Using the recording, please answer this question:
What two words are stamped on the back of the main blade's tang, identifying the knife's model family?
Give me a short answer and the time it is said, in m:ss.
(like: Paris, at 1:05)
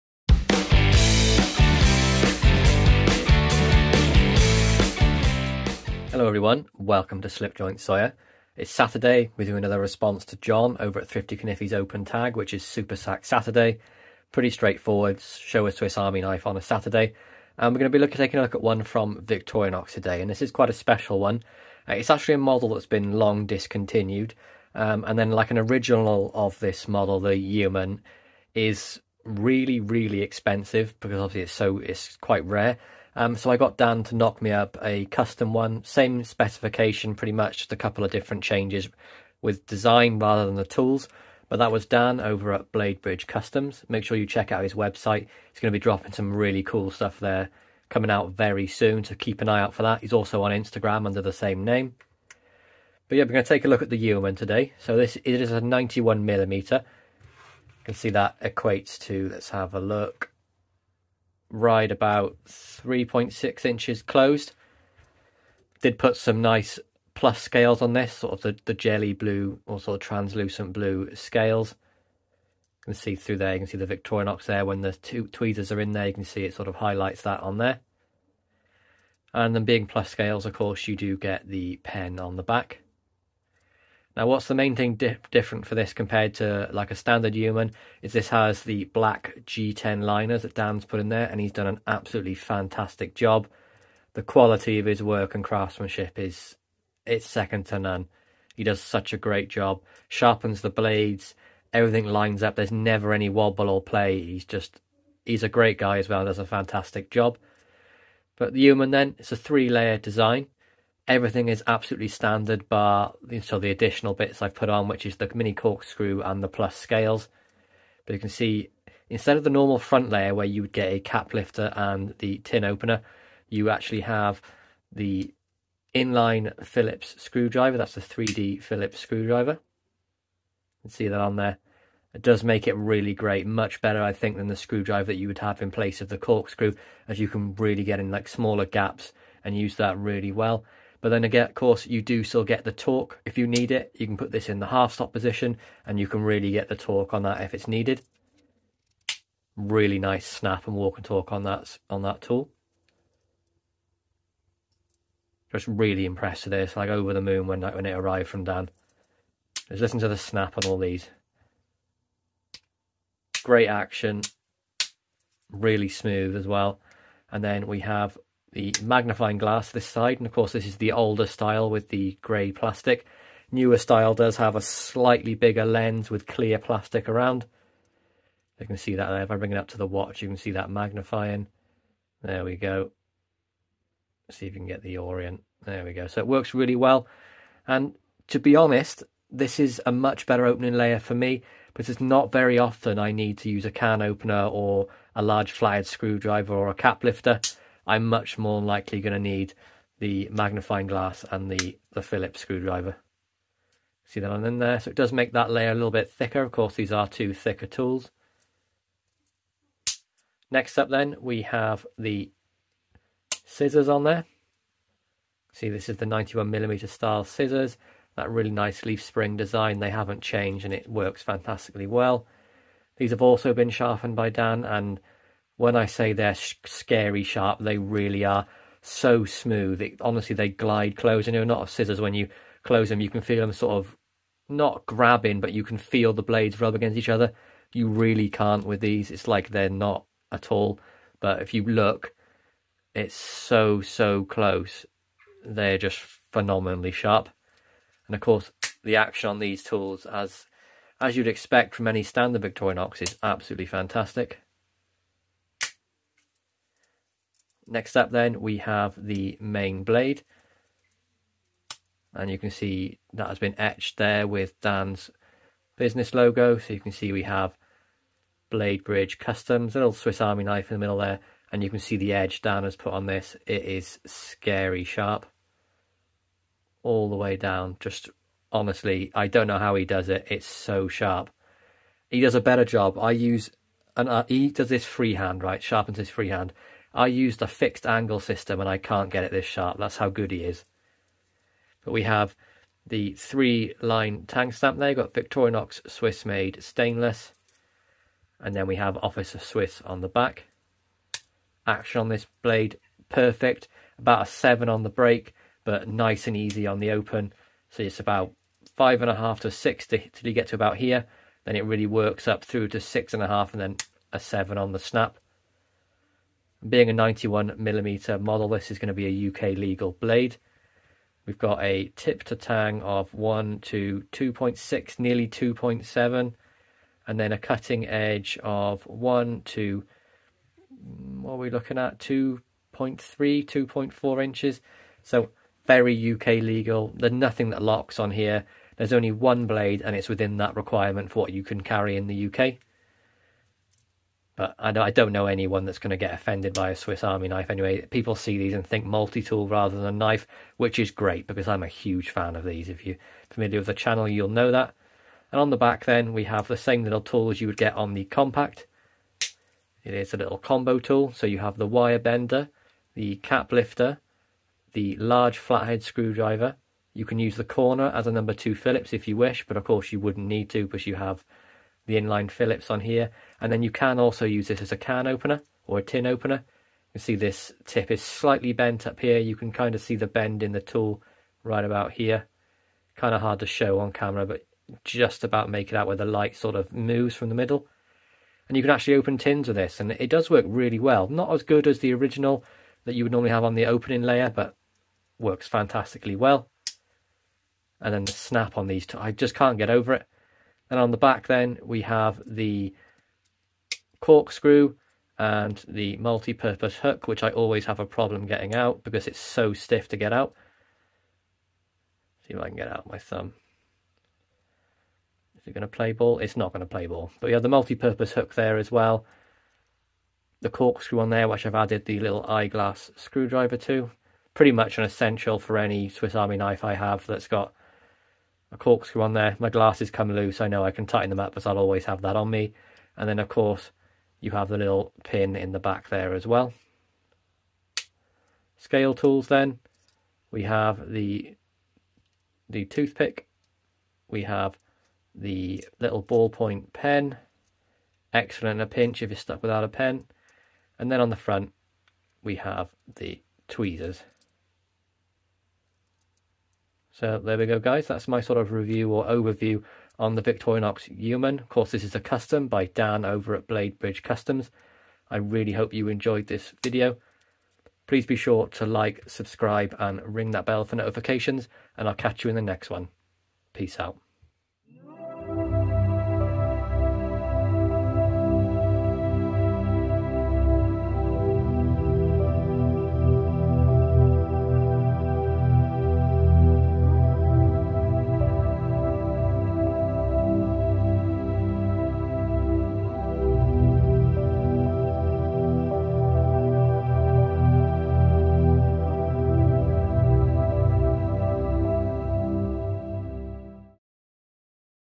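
Officer Swiss, at 4:58.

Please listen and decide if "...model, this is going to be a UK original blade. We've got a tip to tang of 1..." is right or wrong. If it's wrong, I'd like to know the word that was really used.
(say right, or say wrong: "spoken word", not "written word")
wrong: "legal", not "original".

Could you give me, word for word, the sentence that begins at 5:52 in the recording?
If you're familiar with the channel, you'll know that.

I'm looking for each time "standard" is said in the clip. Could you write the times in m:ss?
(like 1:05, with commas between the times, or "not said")
1:26, 1:52, 4:12.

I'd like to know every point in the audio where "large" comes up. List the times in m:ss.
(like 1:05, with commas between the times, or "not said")
3:15, 6:04.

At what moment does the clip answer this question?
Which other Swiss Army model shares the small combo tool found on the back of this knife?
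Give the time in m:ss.
5:57.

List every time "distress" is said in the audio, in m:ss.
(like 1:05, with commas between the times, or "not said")
not said.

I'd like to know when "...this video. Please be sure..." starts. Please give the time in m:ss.
7:46.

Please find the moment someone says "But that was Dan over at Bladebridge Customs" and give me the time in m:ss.
0:41.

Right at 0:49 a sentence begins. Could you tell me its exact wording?
He's also on Instagram under the same name.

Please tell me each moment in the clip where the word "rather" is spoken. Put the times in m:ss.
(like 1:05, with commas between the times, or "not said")
0:40, 5:49.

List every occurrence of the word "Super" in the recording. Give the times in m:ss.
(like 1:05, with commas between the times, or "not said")
0:12.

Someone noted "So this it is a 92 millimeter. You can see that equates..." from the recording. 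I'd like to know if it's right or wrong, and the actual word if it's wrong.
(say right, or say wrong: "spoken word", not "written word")
wrong: "91", not "92".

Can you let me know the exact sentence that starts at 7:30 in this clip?
And then on the front, we have the tweezers.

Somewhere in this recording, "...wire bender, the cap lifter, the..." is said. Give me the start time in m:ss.
6:01.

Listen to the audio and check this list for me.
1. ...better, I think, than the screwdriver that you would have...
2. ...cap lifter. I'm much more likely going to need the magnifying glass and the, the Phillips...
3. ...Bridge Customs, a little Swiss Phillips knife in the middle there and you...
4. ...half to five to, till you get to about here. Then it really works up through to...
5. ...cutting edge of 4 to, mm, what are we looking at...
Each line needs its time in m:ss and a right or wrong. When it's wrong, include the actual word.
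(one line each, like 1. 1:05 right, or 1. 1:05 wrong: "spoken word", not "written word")
1. 2:13 right
2. 3:16 right
3. 4:28 wrong: "Army", not "Phillips"
4. 5:09 wrong: "six", not "five"
5. 5:27 wrong: "1", not "4".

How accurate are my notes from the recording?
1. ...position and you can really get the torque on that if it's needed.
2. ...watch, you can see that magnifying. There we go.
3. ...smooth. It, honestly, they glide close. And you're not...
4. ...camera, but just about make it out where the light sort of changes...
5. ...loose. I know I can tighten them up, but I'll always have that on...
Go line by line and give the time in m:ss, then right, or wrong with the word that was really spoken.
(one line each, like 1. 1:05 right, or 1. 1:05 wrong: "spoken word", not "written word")
1. 2:25 right
2. 2:59 right
3. 3:49 right
4. 6:23 wrong: "moves", not "changes"
5. 7:10 right.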